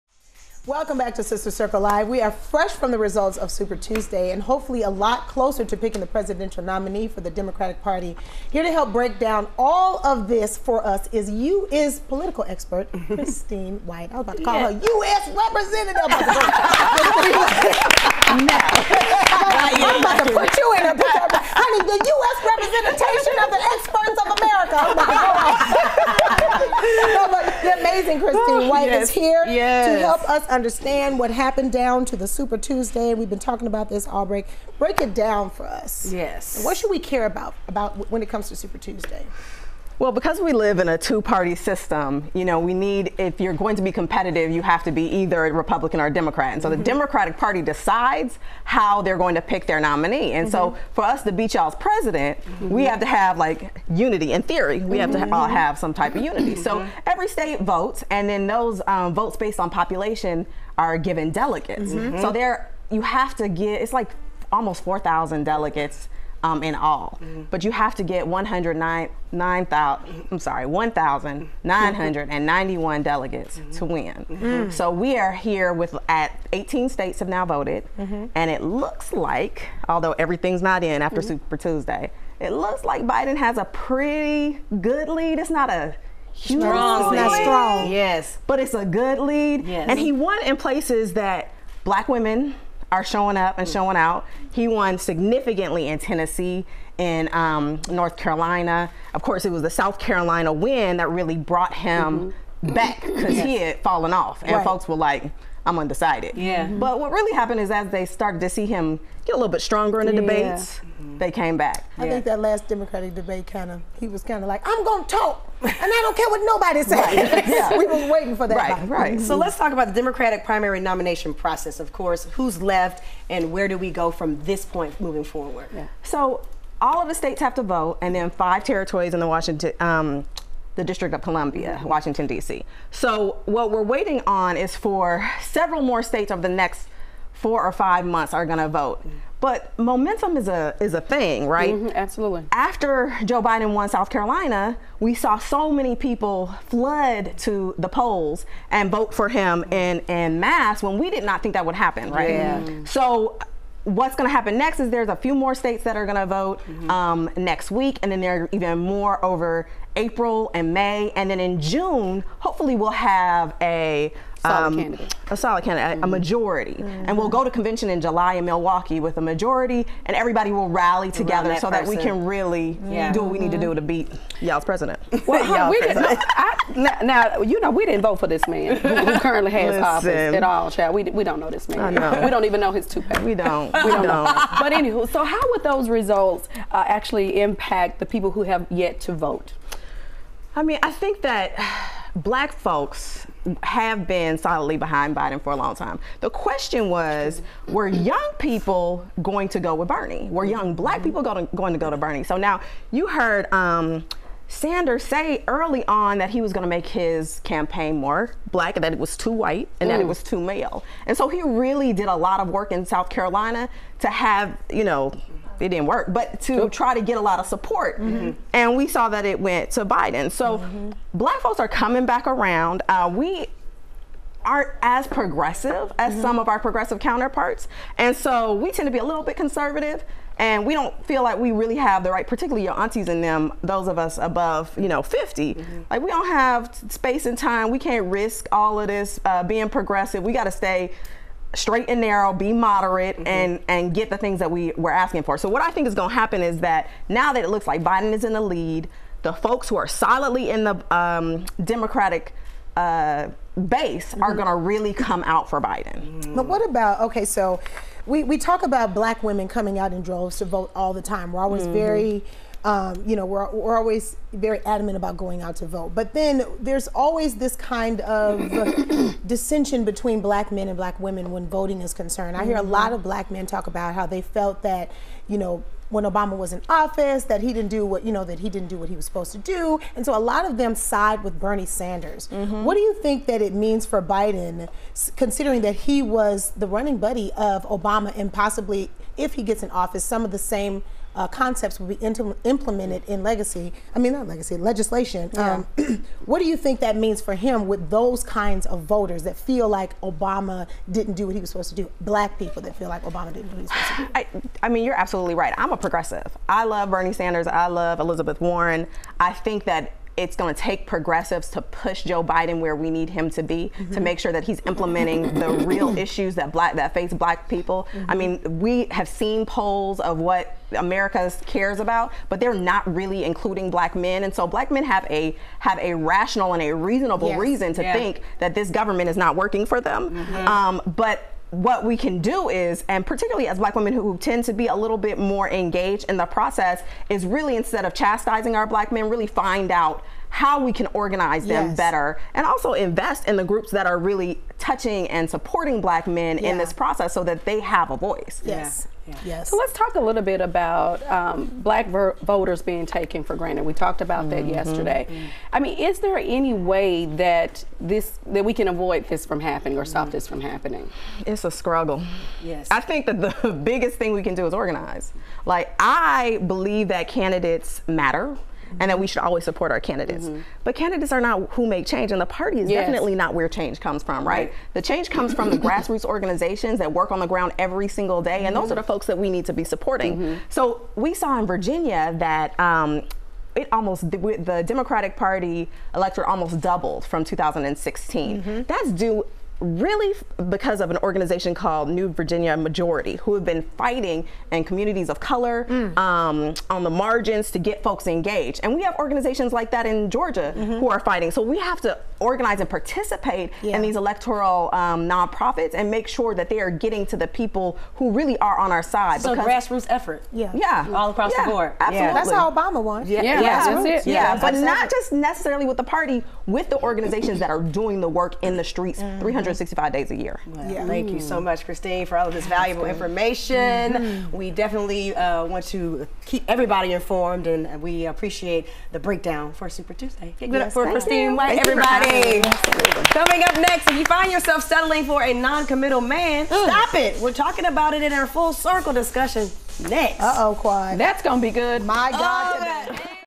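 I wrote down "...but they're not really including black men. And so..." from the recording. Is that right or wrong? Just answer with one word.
right.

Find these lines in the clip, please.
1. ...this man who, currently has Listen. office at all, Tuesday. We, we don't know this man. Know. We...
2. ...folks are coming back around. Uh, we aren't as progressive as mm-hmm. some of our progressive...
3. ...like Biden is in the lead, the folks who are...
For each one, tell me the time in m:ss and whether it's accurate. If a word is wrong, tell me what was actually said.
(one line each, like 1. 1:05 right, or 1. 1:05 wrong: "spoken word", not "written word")
1. 2:58 wrong: "Chad", not "Tuesday"
2. 3:41 right
3. 4:07 right.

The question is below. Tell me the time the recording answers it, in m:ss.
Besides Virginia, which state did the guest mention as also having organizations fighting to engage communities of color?
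6:40.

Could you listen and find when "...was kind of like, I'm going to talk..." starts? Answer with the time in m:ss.
1:54.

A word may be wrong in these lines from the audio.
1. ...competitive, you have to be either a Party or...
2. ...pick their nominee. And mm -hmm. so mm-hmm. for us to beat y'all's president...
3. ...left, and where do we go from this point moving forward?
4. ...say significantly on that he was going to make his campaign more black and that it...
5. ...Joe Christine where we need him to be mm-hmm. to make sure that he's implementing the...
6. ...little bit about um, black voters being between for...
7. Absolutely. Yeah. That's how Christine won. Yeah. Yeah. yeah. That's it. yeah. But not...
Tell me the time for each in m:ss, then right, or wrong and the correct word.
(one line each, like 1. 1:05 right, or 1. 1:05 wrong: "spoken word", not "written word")
1. 0:43 wrong: "Republican", not "Party"
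2. 0:49 right
3. 2:02 right
4. 3:25 wrong: "early", not "significantly"
5. 5:12 wrong: "Biden", not "Christine"
6. 5:49 wrong: "taken", not "between"
7. 6:51 wrong: "Obama", not "Christine".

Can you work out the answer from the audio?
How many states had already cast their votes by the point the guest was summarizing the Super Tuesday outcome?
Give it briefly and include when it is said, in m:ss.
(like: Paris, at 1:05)
18, at 1:16.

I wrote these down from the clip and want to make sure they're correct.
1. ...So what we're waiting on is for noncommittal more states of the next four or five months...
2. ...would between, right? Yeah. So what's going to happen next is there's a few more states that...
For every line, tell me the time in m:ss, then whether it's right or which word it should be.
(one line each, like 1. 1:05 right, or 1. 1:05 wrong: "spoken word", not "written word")
1. 2:12 wrong: "several", not "noncommittal"
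2. 2:31 wrong: "happen", not "between".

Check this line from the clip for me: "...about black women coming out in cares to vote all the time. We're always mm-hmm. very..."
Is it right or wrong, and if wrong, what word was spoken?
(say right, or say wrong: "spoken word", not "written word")
wrong: "droves", not "cares".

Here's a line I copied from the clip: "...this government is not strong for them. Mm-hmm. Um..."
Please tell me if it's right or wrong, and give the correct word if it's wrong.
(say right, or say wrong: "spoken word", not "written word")
wrong: "working", not "strong".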